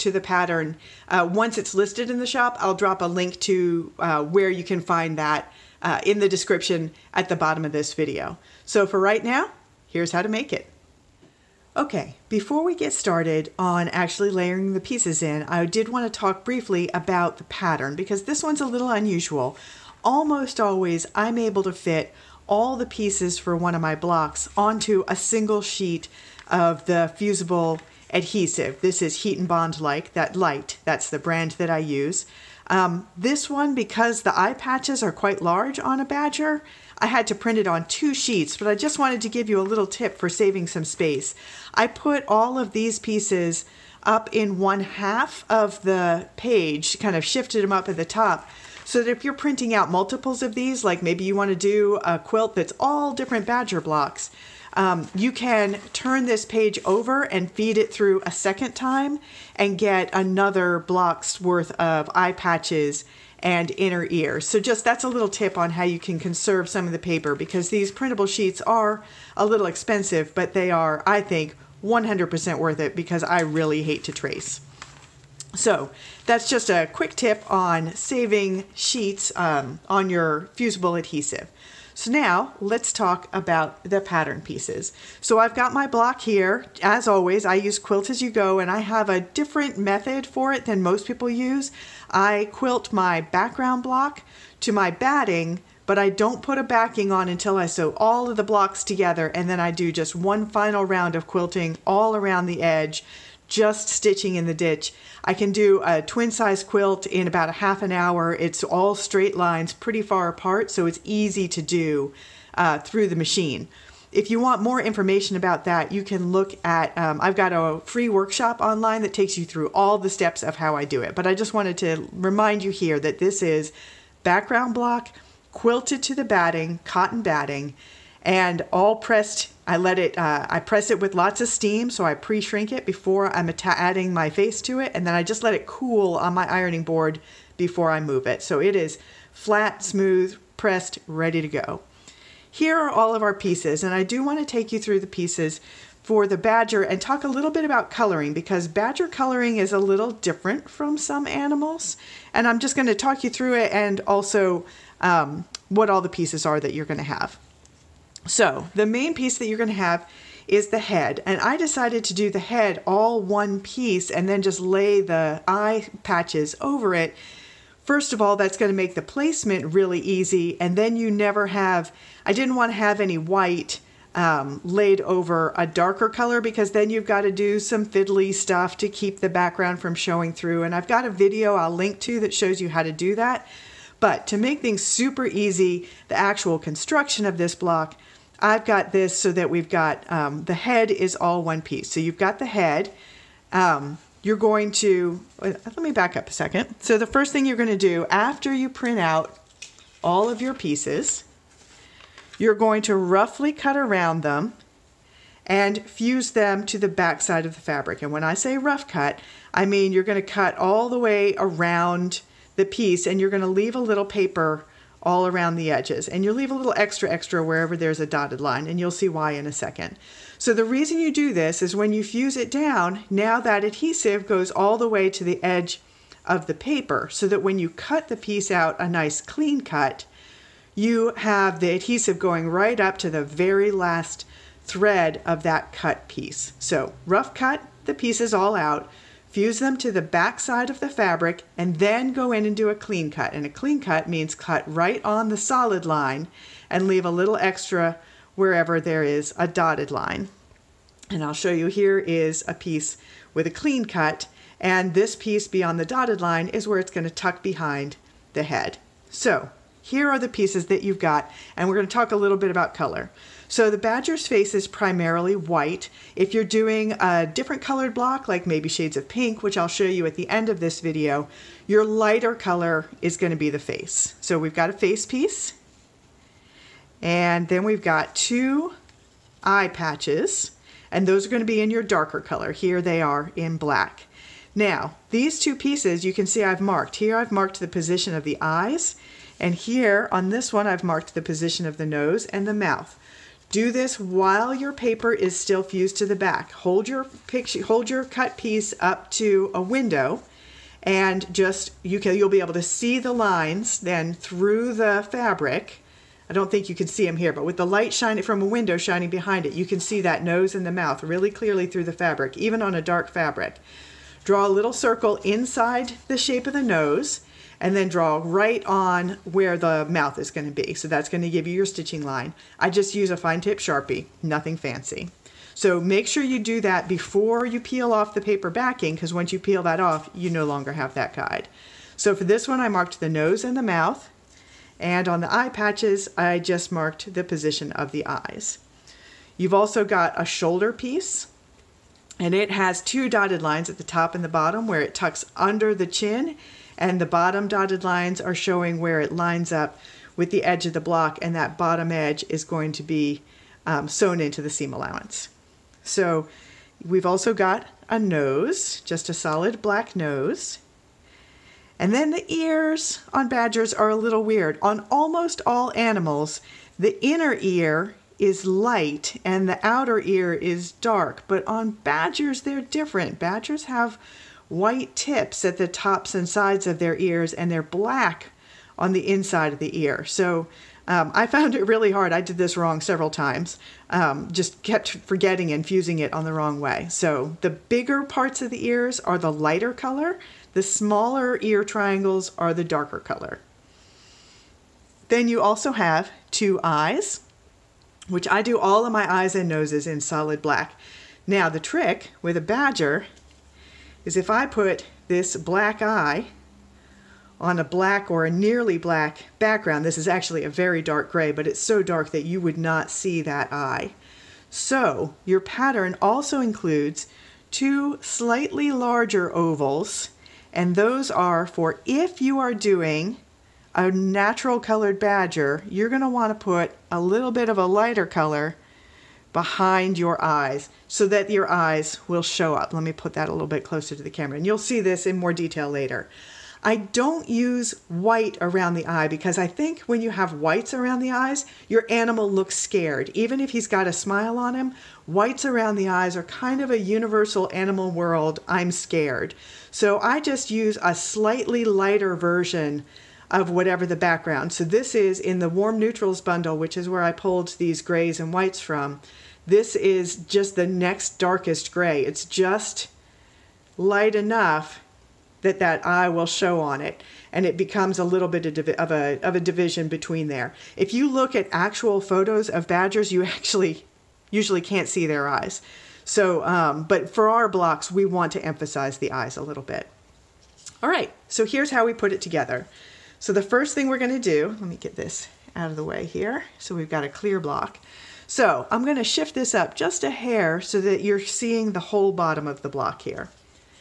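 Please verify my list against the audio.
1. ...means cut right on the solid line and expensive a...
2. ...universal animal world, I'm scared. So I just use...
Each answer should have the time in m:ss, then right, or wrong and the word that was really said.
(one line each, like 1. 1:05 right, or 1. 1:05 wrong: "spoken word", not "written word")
1. 4:04 wrong: "leave", not "expensive"
2. 7:26 right.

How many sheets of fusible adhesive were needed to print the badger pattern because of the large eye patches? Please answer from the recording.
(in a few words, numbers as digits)
2.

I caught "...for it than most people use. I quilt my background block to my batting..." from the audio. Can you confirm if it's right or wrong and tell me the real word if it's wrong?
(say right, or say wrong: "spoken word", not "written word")
right.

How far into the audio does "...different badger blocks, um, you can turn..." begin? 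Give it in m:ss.
0:53.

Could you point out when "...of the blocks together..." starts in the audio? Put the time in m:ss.
1:38.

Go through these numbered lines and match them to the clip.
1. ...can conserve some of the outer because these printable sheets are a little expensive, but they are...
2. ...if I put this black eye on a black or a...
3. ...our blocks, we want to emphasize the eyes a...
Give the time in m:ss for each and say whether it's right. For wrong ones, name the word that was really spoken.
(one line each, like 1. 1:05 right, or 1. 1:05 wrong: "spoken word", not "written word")
1. 1:05 wrong: "paper", not "outer"
2. 6:44 right
3. 7:57 right.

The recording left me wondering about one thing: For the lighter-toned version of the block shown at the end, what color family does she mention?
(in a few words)
pink.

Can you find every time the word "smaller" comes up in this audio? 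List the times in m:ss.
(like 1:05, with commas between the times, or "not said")
6:30.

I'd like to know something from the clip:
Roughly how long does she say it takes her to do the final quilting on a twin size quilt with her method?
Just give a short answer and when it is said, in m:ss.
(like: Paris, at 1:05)
half an hour, at 1:47.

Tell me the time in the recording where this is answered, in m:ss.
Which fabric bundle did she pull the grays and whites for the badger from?
7:35.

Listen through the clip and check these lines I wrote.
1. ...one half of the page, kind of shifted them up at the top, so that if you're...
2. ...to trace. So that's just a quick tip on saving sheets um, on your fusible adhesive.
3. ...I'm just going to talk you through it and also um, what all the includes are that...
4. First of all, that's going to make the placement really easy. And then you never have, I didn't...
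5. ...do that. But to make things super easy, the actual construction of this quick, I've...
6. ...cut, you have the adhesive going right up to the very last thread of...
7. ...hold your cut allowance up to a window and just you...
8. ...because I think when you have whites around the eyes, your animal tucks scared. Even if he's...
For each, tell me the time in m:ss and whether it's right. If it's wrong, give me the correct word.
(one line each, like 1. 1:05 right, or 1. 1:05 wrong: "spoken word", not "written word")
1. 0:44 right
2. 1:14 right
3. 2:32 wrong: "pieces", not "includes"
4. 2:47 right
5. 3:02 wrong: "block", not "quick"
6. 3:49 right
7. 4:57 wrong: "piece", not "allowance"
8. 7:19 wrong: "looks", not "tucks".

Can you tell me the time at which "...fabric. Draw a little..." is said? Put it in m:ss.
5:13.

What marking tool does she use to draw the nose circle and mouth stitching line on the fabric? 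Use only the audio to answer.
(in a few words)
fine tip Sharpie.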